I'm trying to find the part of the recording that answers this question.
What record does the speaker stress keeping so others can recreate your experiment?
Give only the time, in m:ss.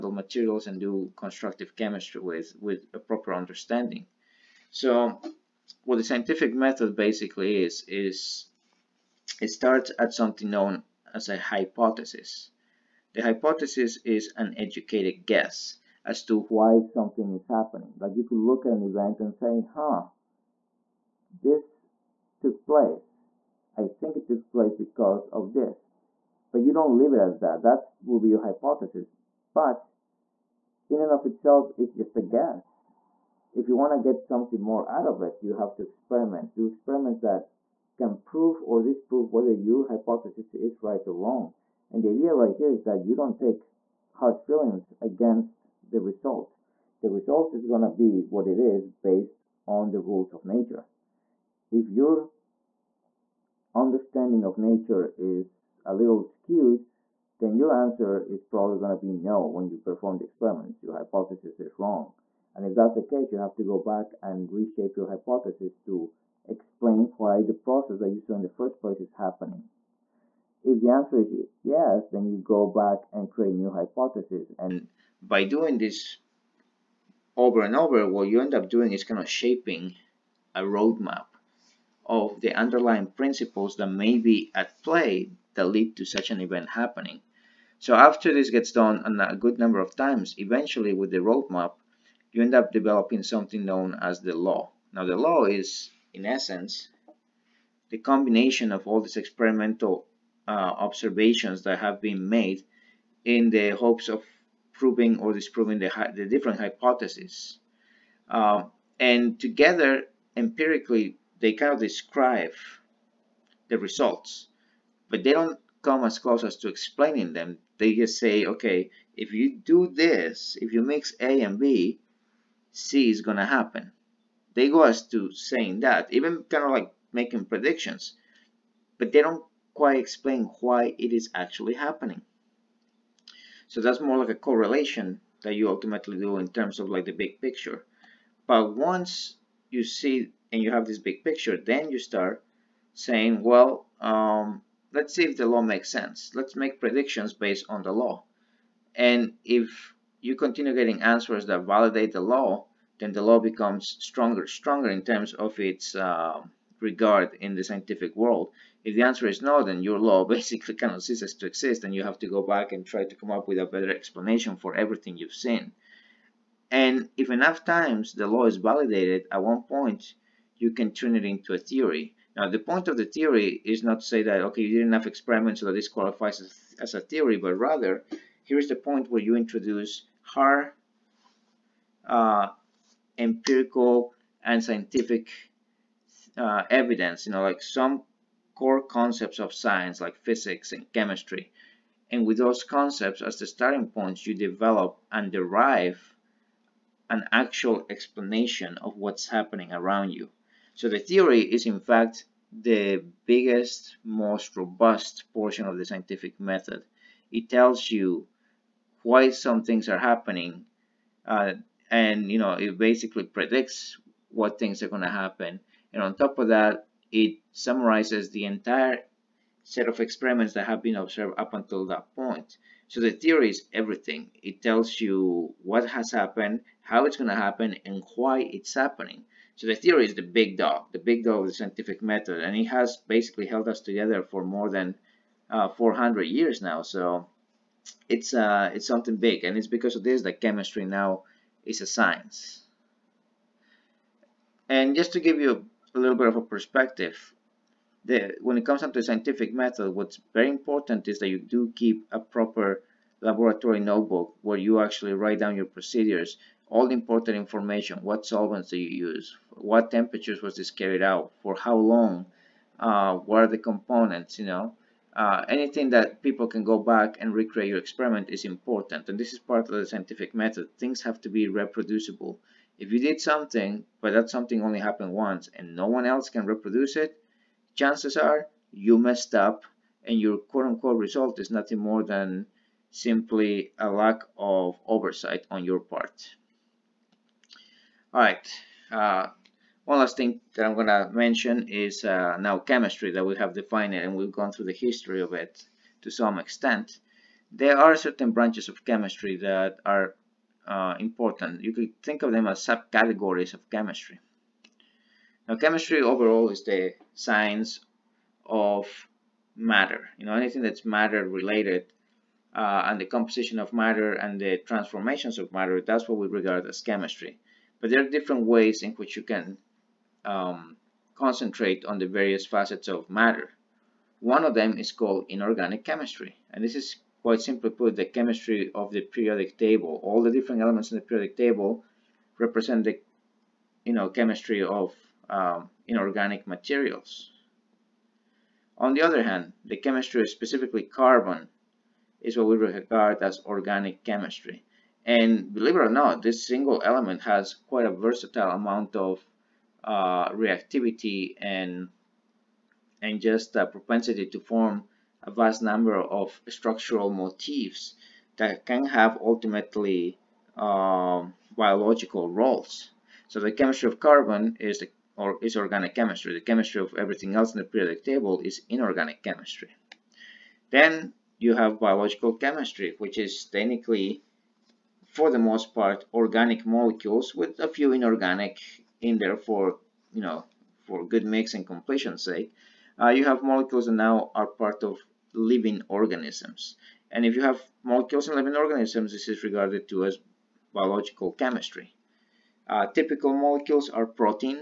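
4:13.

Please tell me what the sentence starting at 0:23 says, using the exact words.
I think it took place because of this.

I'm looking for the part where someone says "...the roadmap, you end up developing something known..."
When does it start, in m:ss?
1:31.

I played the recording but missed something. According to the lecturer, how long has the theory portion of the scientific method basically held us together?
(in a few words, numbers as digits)
More than 400 years.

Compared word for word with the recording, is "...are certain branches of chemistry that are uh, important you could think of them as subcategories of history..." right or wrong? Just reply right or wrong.
wrong.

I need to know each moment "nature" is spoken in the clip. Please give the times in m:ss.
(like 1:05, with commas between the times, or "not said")
0:50, 0:54.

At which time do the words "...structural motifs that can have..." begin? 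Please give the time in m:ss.
5:56.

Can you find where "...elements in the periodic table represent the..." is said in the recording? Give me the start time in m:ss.
5:30.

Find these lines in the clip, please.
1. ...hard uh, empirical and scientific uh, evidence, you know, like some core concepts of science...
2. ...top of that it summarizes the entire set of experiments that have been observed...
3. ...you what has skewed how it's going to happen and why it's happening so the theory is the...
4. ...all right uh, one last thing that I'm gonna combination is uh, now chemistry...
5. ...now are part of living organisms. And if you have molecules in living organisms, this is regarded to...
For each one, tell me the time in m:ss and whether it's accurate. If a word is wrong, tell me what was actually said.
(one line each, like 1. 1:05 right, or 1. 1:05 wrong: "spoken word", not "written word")
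1. 3:00 right
2. 3:36 right
3. 3:45 wrong: "happened", not "skewed"
4. 4:48 wrong: "mention", not "combination"
5. 6:24 right.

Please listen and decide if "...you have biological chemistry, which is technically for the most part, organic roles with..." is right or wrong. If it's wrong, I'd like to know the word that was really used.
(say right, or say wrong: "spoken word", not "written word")
wrong: "molecules", not "roles".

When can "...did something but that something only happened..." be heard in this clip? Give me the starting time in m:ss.
4:32.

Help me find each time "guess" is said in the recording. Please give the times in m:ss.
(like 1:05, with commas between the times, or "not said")
0:15, 0:32.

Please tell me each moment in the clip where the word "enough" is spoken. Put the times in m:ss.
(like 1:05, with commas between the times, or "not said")
2:47, 2:54.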